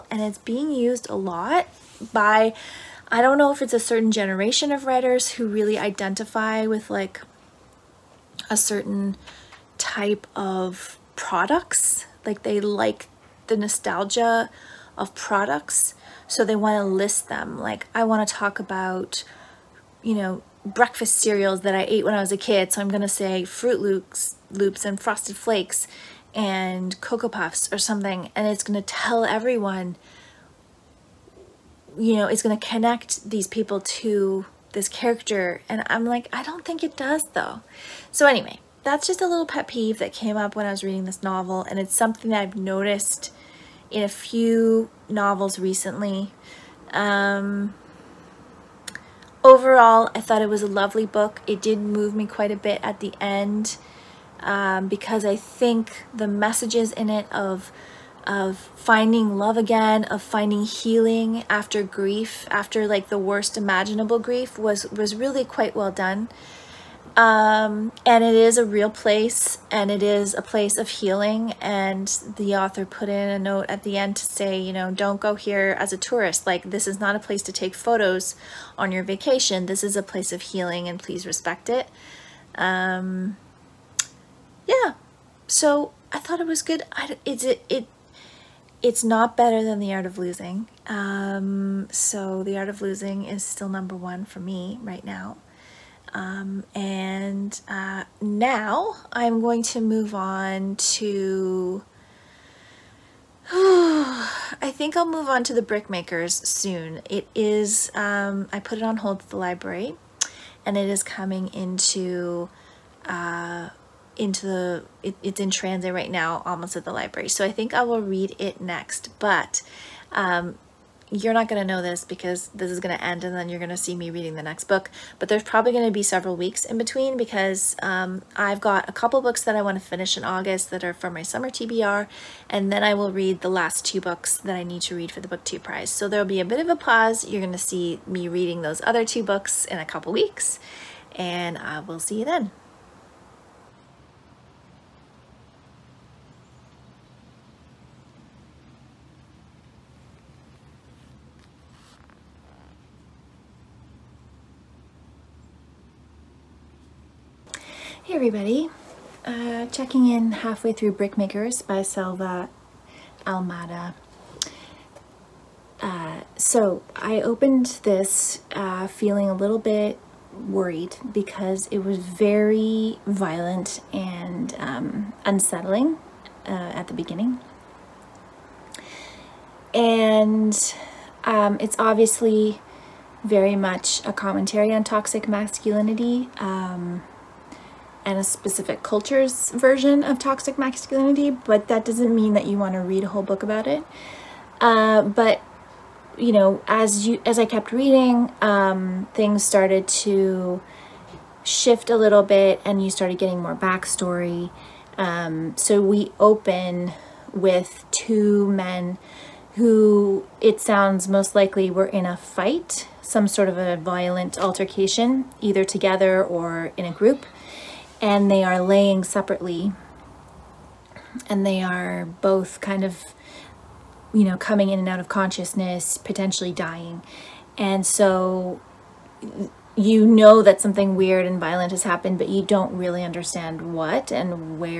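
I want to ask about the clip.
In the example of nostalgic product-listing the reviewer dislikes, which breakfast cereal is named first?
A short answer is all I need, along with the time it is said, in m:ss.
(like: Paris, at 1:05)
Froot Loops, at 0:23.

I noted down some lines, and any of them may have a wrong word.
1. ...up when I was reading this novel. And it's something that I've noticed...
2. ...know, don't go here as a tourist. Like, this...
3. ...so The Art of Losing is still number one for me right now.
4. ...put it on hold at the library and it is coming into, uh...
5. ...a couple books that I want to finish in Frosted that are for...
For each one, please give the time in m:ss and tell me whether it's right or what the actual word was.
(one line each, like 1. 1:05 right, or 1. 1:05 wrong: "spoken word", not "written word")
1. 0:40 right
2. 1:14 right
3. 1:31 right
4. 1:48 right
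5. 2:08 wrong: "August", not "Frosted".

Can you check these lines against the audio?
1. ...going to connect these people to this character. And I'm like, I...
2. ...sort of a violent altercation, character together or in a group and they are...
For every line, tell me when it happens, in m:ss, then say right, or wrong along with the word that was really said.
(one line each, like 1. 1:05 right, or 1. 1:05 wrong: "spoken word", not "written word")
1. 0:32 right
2. 3:33 wrong: "either", not "character".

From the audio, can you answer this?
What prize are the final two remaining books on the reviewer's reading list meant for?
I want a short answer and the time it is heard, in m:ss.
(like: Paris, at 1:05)
BookTube Prize, at 2:15.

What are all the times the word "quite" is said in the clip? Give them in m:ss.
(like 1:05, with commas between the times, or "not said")
0:52, 1:05.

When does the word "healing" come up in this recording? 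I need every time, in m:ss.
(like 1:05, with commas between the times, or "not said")
1:00, 1:10, 1:20.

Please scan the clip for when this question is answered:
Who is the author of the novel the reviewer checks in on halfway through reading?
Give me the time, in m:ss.
2:41.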